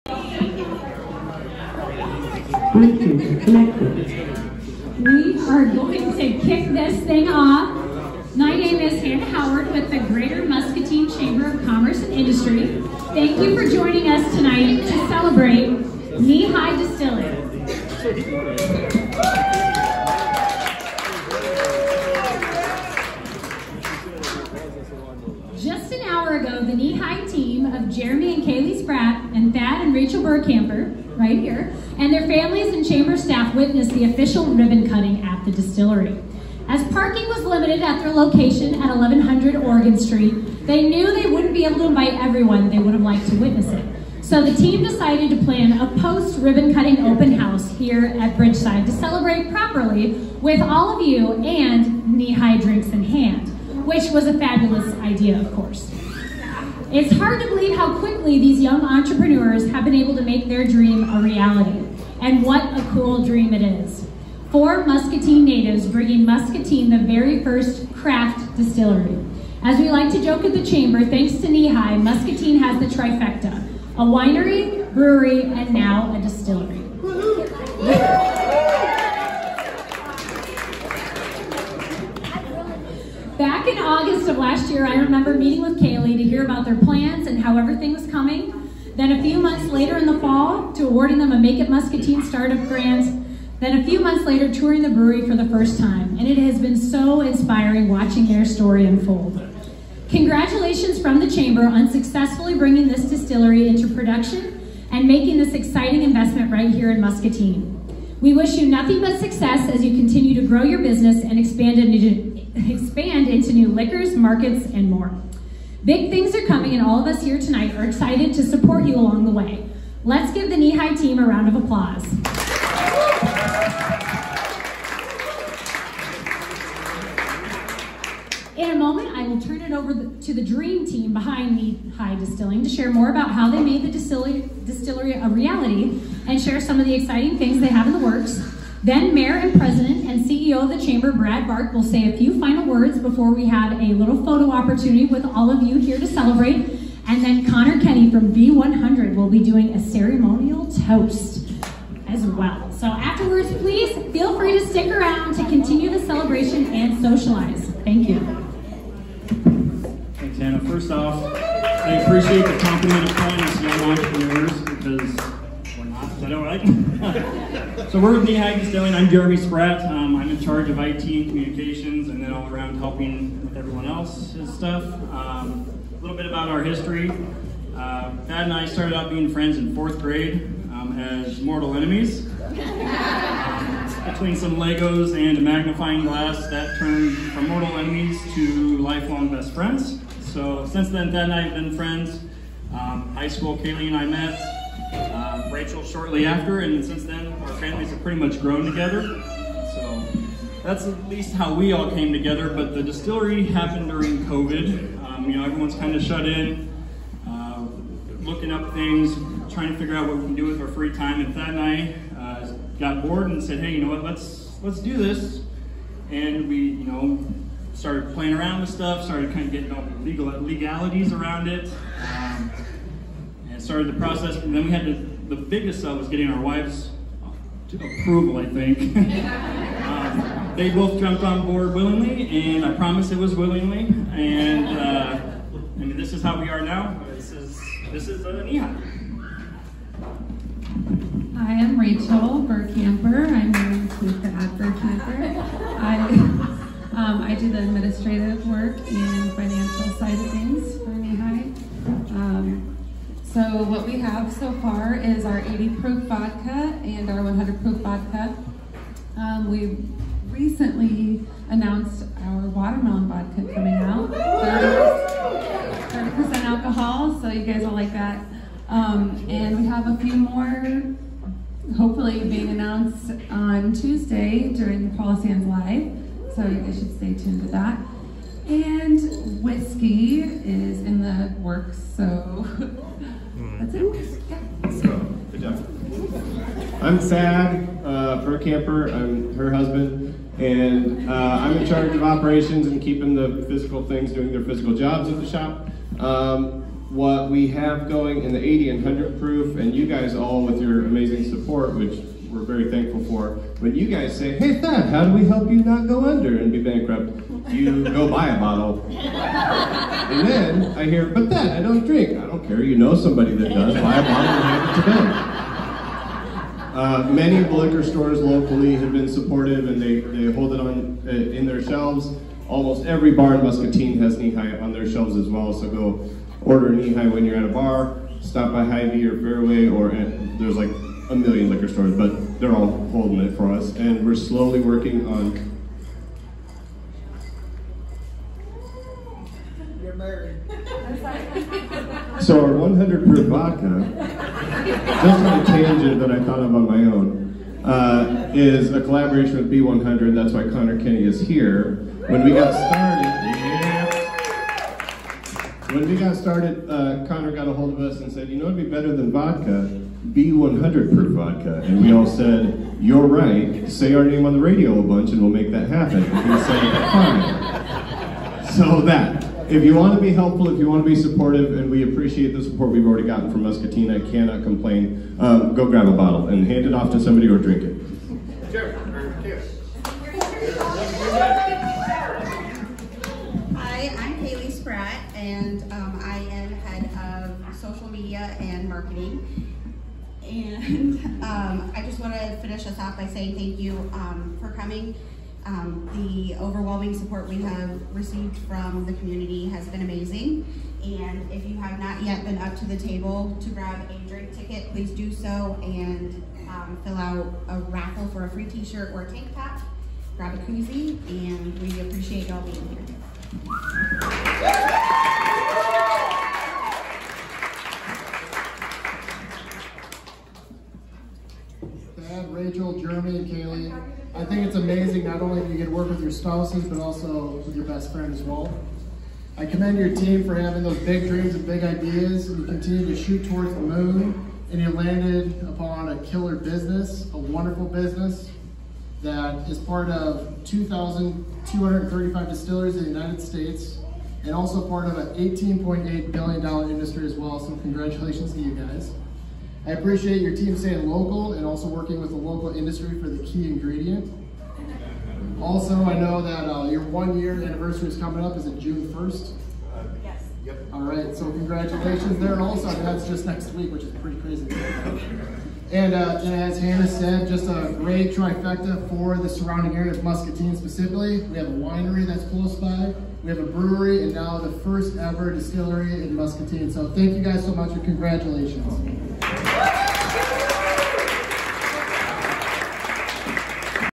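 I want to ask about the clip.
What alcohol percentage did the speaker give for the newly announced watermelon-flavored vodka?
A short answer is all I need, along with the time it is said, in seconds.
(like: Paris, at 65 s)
30%, at 264 s.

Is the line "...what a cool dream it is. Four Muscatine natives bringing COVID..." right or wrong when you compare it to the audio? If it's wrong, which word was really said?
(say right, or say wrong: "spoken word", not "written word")
wrong: "Muscatine", not "COVID".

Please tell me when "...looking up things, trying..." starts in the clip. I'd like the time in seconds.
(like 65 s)
208 s.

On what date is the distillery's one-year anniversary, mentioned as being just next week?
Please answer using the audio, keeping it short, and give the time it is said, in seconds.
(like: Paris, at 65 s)
June 1st, at 458 s.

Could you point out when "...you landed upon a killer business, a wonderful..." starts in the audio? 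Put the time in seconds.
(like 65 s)
434 s.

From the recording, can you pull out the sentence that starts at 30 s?
Rauschenberg camper right here, and their families and chamber staff witnessed the official ribbon cutting at the distillery.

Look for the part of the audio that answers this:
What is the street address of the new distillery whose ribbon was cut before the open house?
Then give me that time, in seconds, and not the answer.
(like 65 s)
38 s.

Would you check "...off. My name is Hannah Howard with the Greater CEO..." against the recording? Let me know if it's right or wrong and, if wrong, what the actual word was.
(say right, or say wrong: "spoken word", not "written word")
wrong: "Muscatine", not "CEO".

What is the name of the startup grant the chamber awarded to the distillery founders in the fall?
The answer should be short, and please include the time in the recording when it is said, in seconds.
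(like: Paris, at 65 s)
Make It Muscatine, at 91 s.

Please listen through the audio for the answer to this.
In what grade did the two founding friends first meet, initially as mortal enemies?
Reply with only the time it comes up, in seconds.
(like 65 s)
179 s.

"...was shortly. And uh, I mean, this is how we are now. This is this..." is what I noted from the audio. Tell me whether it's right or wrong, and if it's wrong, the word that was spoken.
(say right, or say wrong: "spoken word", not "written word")
wrong: "willingly", not "shortly".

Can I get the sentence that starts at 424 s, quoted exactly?
I think it's amazing not only that you get to work with your spouses, but also with your best friend as well.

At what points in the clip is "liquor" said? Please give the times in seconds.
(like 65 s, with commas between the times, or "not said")
113 s, 317 s, 331 s.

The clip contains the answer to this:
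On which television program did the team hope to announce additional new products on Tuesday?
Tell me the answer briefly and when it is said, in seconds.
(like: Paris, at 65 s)
Paula Sands Live, at 274 s.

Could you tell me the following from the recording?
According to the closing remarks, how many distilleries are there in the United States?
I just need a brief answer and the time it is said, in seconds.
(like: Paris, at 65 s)
2,235, at 440 s.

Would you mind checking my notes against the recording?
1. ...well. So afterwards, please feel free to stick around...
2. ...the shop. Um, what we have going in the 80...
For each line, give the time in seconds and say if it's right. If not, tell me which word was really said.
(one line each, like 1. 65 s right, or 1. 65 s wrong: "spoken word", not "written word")
1. 152 s right
2. 295 s right.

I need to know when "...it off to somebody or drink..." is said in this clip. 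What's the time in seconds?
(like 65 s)
376 s.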